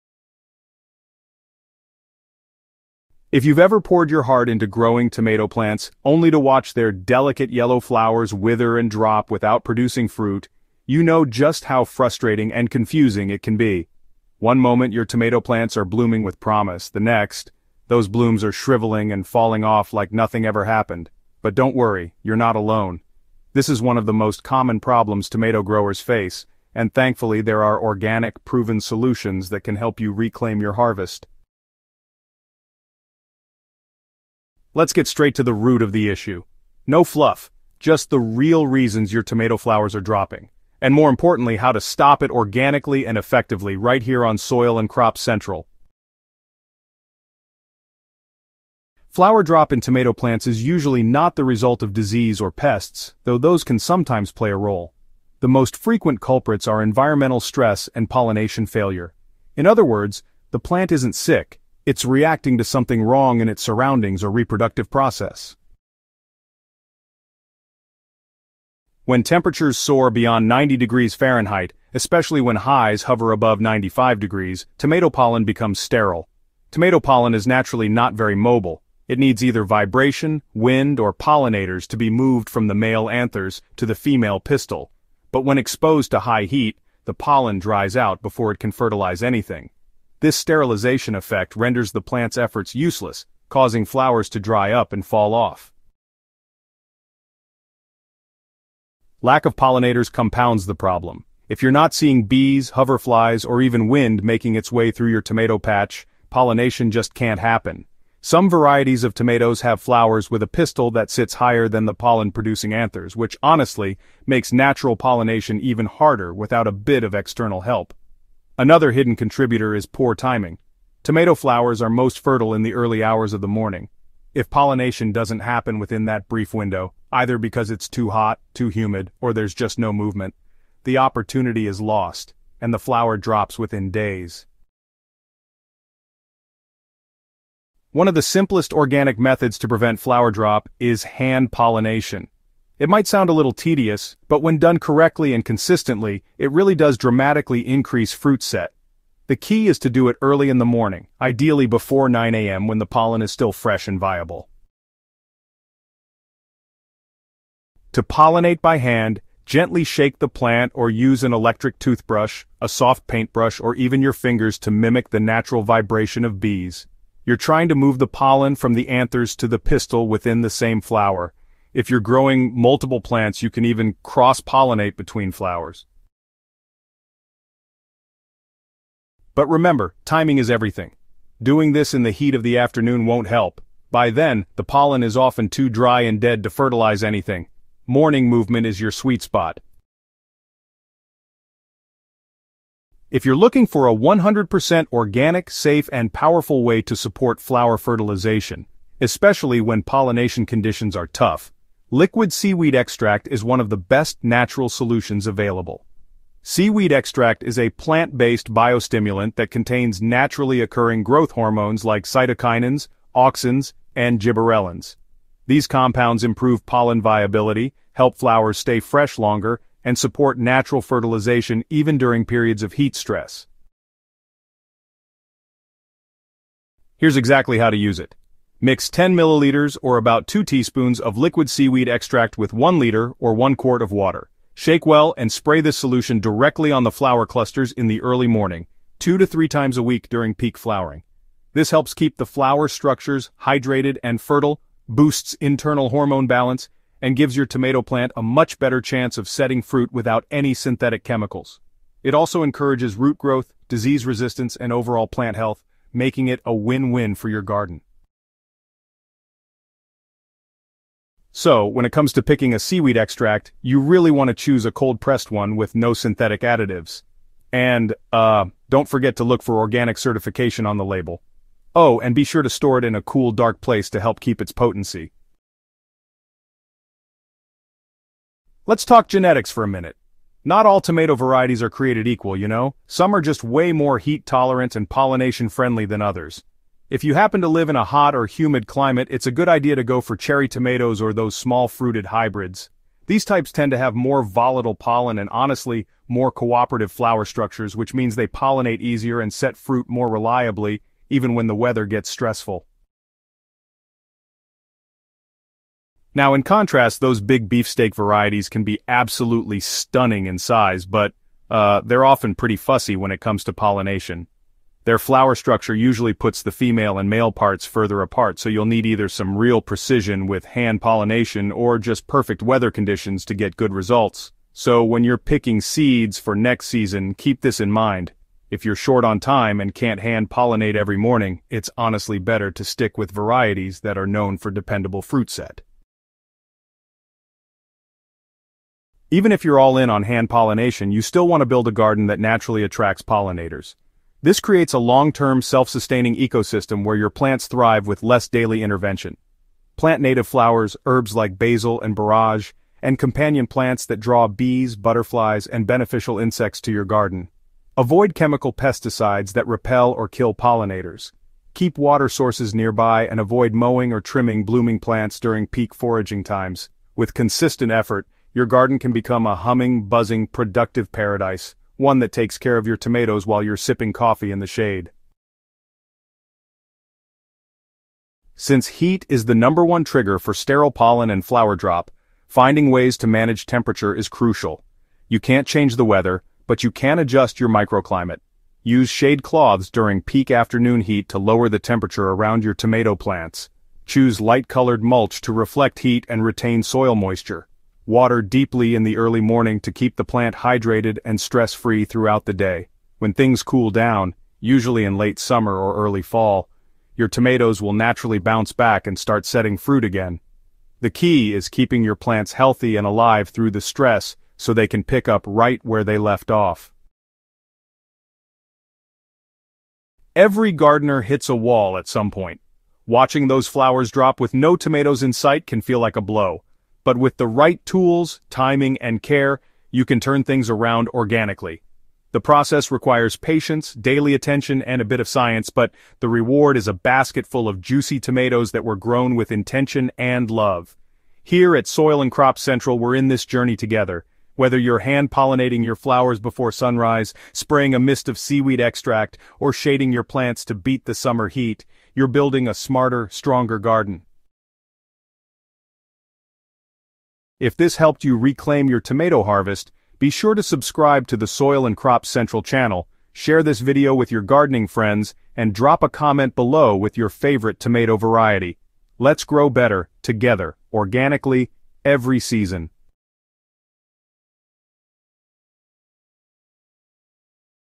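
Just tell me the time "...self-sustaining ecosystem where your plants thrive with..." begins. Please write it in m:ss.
5:45.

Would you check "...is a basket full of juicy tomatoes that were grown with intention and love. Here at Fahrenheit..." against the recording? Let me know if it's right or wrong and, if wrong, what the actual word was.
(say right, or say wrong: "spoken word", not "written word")
wrong: "Soil", not "Fahrenheit".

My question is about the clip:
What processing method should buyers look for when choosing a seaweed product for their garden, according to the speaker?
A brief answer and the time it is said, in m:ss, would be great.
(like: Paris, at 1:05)
cold-pressed, at 4:24.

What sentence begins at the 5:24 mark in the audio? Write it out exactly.
So when you're picking seeds for next season, keep this in mind.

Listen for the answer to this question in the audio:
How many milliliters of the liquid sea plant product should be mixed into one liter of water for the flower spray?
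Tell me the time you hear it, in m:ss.
3:48.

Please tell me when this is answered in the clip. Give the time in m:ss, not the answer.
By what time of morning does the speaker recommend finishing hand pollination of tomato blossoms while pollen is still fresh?
2:32.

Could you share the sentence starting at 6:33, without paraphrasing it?
Choose light-colored mulch to reflect heat and retain soil moisture.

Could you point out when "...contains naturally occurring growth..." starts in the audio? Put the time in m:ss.
3:29.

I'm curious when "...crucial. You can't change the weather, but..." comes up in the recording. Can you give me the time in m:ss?
6:24.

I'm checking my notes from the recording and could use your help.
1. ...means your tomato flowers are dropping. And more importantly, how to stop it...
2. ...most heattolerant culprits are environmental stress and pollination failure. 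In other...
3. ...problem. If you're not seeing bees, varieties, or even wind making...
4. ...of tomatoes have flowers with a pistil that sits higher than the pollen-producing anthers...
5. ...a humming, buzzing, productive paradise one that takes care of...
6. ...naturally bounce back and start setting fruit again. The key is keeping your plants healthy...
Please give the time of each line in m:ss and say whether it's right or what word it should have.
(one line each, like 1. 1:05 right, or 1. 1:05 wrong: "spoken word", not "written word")
1. 0:38 wrong: "reasons", not "means"
2. 0:55 wrong: "frequent", not "heattolerant"
3. 1:40 wrong: "hoverflies", not "varieties"
4. 1:49 right
5. 6:09 right
6. 6:47 right.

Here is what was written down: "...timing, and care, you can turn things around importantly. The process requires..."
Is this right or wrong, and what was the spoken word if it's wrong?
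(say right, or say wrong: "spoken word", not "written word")
wrong: "organically", not "importantly".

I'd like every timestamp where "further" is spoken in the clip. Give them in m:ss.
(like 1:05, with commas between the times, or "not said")
5:17.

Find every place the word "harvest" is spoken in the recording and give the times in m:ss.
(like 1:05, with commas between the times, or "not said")
0:30, 7:39.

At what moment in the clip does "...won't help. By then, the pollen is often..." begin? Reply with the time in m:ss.
3:03.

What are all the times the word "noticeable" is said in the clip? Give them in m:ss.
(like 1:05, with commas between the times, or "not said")
not said.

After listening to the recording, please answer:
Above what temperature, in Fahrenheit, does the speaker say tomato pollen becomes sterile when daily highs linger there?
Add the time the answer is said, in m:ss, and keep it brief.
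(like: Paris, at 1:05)
95 degrees, at 1:13.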